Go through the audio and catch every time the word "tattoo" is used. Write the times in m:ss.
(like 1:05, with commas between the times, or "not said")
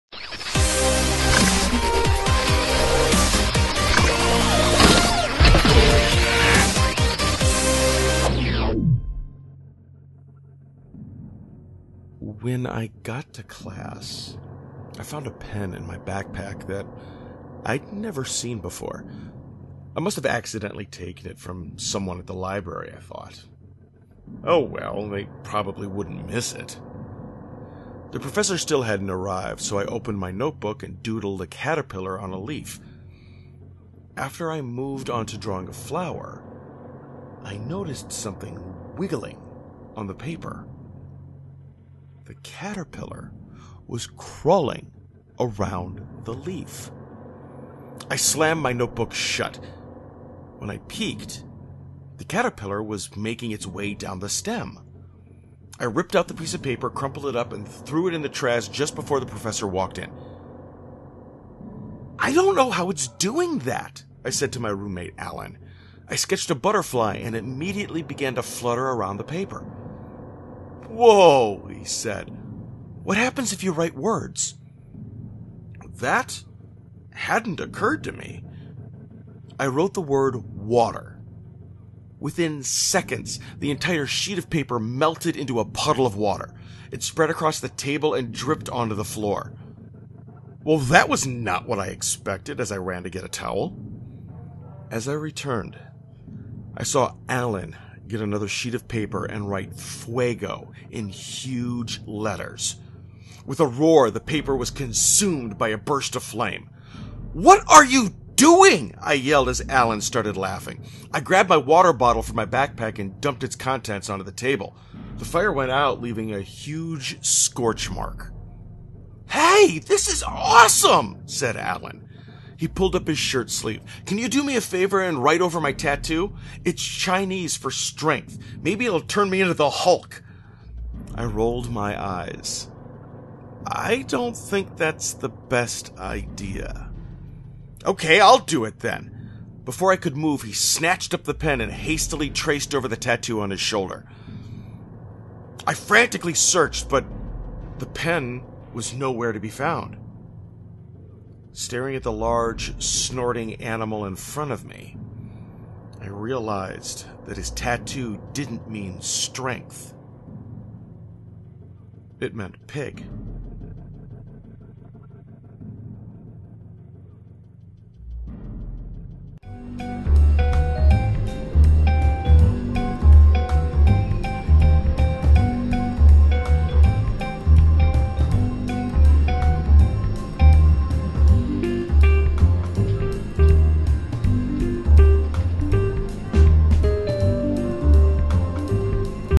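2:05, 2:22, 2:37.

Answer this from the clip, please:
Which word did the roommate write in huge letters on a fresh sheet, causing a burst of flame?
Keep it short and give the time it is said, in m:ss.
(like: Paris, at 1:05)
Fuego, at 1:39.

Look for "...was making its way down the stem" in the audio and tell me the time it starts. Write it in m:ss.
0:52.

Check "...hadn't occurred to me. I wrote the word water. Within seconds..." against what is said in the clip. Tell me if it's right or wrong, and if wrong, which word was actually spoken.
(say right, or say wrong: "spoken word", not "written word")
right.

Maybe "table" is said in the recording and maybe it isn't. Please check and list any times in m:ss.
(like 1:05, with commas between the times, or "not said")
1:27, 1:54.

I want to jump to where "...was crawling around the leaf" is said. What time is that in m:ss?
0:43.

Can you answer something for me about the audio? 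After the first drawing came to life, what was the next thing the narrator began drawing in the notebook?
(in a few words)
a flower.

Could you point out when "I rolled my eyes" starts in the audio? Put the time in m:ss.
2:11.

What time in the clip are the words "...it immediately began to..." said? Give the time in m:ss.
1:07.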